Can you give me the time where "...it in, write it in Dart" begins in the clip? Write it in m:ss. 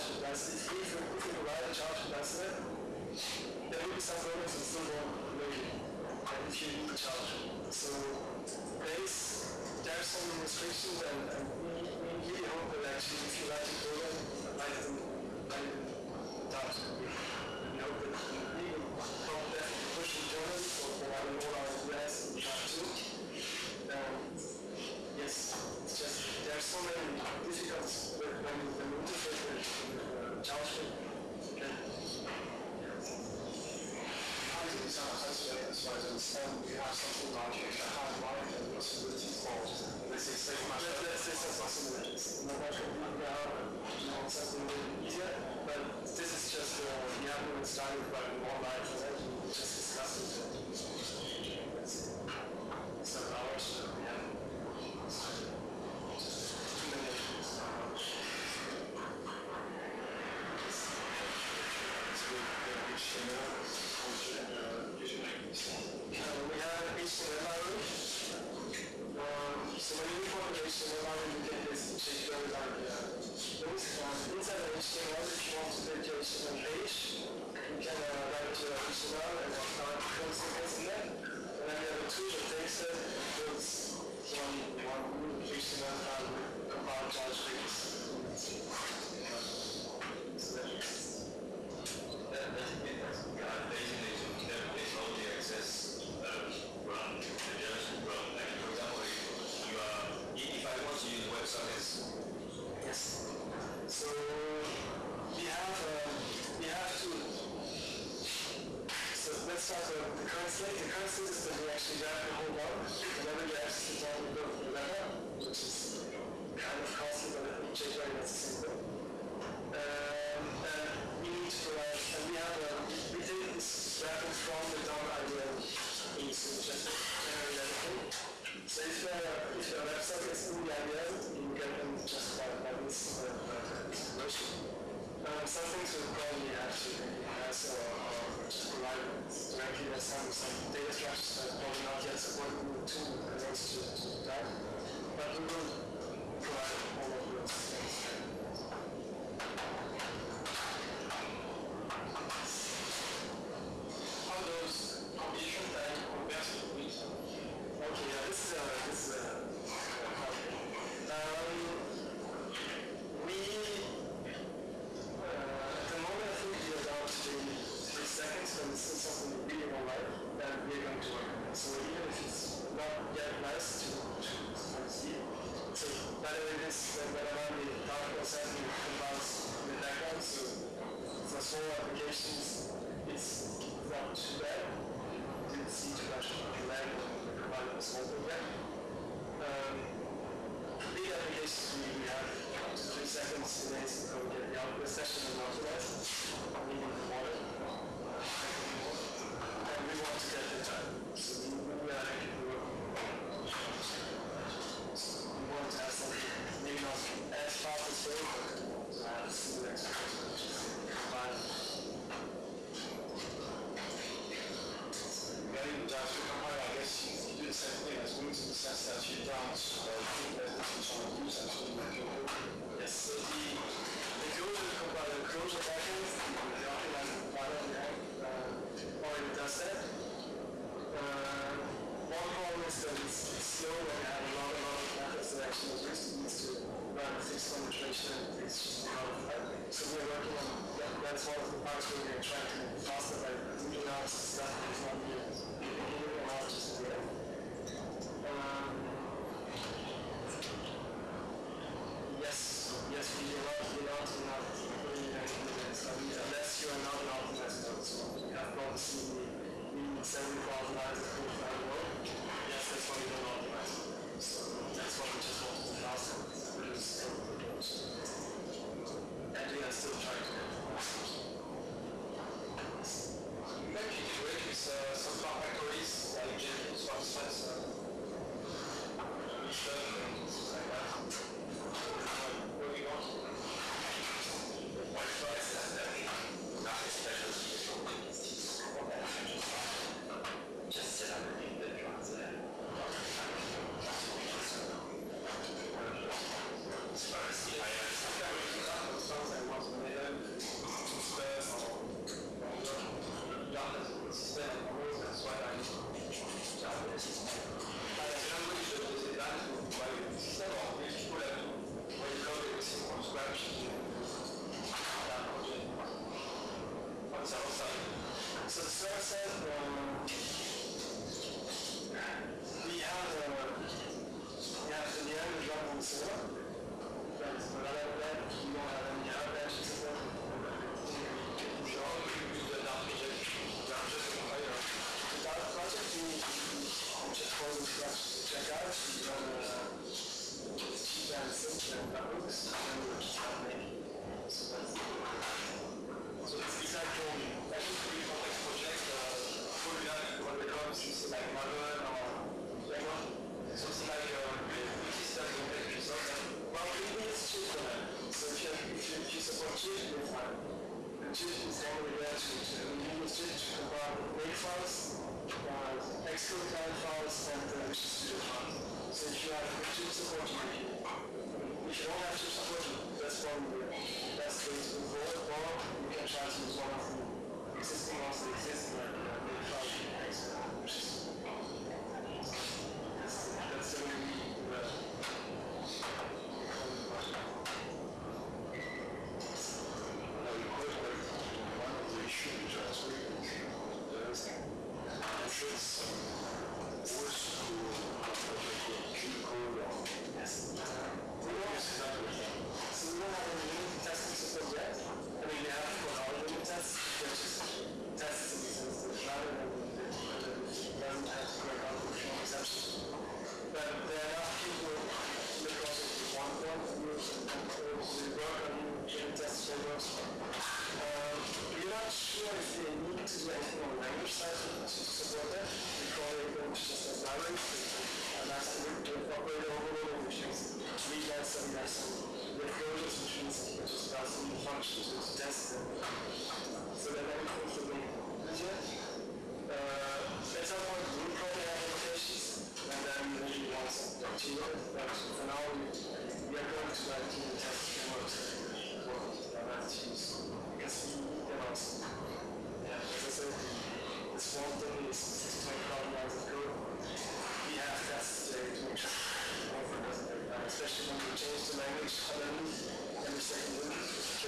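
0:14.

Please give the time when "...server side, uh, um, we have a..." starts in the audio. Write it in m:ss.
5:18.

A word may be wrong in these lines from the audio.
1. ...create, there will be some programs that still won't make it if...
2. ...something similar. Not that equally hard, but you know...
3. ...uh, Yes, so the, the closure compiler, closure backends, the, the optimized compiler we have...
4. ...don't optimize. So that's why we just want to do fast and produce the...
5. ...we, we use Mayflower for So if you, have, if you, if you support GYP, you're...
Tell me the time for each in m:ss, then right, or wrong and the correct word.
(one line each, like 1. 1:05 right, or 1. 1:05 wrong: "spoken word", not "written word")
1. 0:02 wrong: "isolate", not "create"
2. 0:41 wrong: "completely", not "equally"
3. 3:39 right
4. 4:23 right
5. 5:56 wrong: "GYP", not "Mayflower".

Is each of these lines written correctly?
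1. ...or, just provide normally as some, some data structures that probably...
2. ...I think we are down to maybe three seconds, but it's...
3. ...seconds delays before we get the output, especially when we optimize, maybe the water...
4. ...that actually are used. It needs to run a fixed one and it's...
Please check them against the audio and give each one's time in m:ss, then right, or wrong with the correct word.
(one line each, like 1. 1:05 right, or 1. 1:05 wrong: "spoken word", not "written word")
1. 2:17 wrong: "directly", not "normally"
2. 2:46 right
3. 3:13 right
4. 3:55 right.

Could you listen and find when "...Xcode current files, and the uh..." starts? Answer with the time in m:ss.
6:06.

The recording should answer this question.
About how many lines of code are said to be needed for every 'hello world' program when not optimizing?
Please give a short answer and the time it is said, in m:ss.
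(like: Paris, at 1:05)
70,000, at 4:20.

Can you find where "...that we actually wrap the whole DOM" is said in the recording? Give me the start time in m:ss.
1:51.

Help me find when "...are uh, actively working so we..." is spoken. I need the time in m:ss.
3:21.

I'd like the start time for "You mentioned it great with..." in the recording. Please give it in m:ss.
4:31.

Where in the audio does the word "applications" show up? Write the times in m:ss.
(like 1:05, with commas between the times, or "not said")
3:01, 3:11.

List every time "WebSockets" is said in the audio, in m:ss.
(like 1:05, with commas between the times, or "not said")
1:41, 2:09.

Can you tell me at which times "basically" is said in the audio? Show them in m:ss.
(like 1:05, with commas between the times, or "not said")
1:11, 1:33.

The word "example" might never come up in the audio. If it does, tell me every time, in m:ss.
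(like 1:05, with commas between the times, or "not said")
1:38.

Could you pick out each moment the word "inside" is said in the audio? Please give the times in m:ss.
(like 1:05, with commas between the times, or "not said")
1:13.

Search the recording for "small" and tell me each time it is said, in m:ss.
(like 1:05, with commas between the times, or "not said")
3:01, 3:07.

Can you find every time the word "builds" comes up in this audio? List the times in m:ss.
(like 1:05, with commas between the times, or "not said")
1:23, 5:12.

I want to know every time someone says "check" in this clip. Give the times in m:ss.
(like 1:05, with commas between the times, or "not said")
1:11, 5:38.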